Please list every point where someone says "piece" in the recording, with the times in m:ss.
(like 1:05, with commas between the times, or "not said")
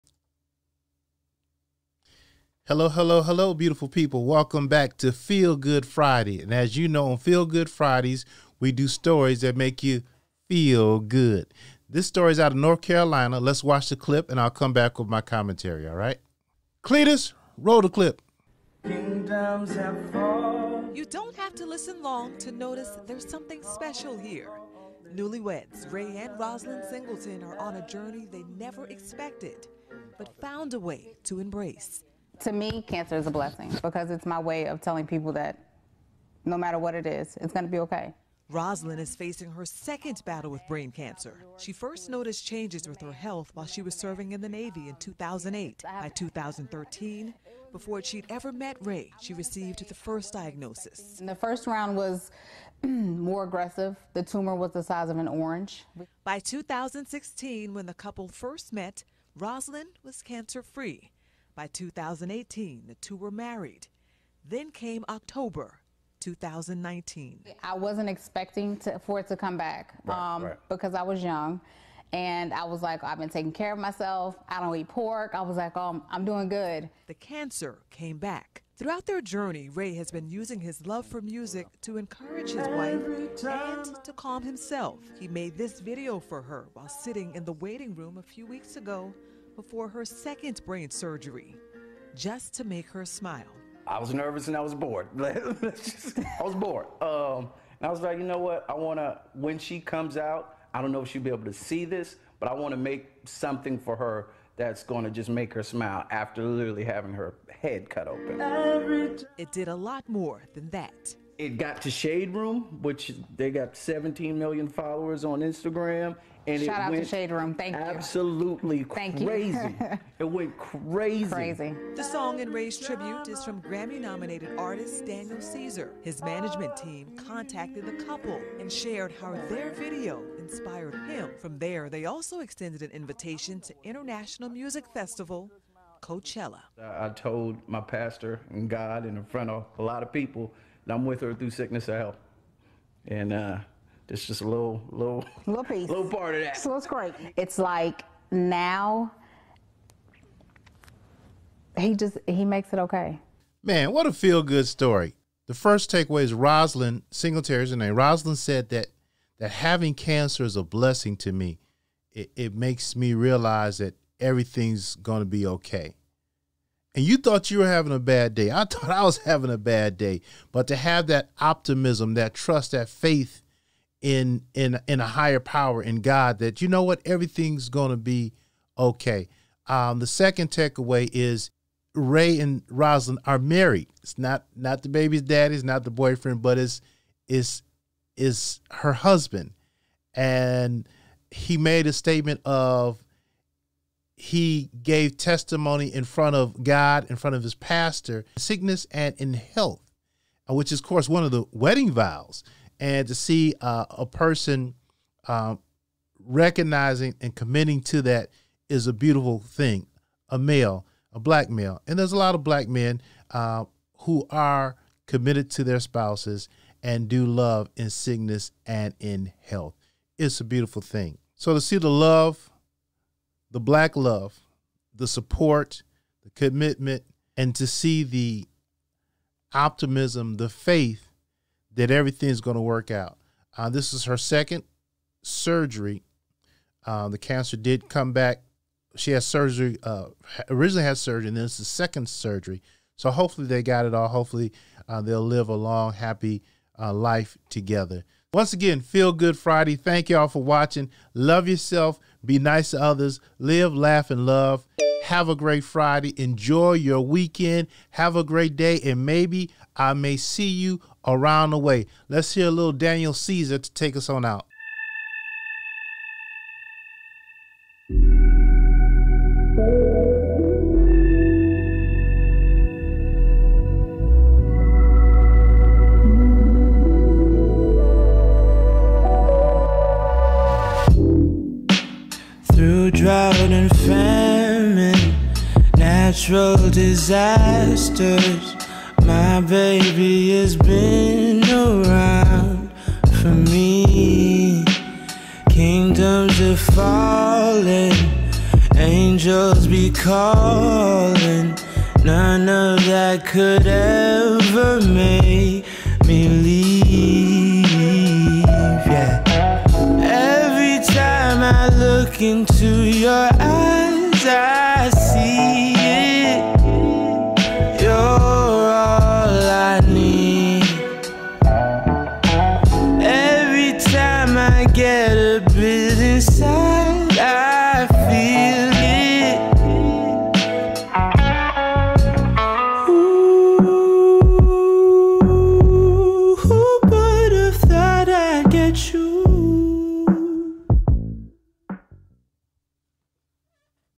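2:25.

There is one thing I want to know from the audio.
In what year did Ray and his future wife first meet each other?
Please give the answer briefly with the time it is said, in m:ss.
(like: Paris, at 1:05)
2016, at 0:56.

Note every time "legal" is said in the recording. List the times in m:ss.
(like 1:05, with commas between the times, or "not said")
not said.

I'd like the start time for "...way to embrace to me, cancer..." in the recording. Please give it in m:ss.
0:30.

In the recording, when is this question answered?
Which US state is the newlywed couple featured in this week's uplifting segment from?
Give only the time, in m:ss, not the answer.
0:12.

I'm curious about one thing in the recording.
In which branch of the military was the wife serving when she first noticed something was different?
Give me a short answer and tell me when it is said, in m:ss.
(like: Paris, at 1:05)
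Navy, at 0:44.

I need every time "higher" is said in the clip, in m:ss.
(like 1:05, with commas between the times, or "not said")
2:55.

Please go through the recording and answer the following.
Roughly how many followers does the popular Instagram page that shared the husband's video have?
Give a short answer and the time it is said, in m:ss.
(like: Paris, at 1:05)
17 million, at 1:53.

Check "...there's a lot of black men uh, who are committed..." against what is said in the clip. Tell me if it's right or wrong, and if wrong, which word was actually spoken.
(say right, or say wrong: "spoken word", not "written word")
right.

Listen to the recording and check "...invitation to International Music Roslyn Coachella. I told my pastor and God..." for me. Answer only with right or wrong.
wrong.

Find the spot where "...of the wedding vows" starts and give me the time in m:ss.
3:21.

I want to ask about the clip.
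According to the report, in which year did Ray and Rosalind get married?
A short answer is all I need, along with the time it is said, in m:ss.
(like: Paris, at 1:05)
2018, at 1:01.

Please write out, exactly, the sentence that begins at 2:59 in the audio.
Um, the second takeaway is Ray and Rosalind are married.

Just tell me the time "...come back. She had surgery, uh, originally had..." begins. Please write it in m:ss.
3:57.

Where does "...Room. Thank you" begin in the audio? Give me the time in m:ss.
1:57.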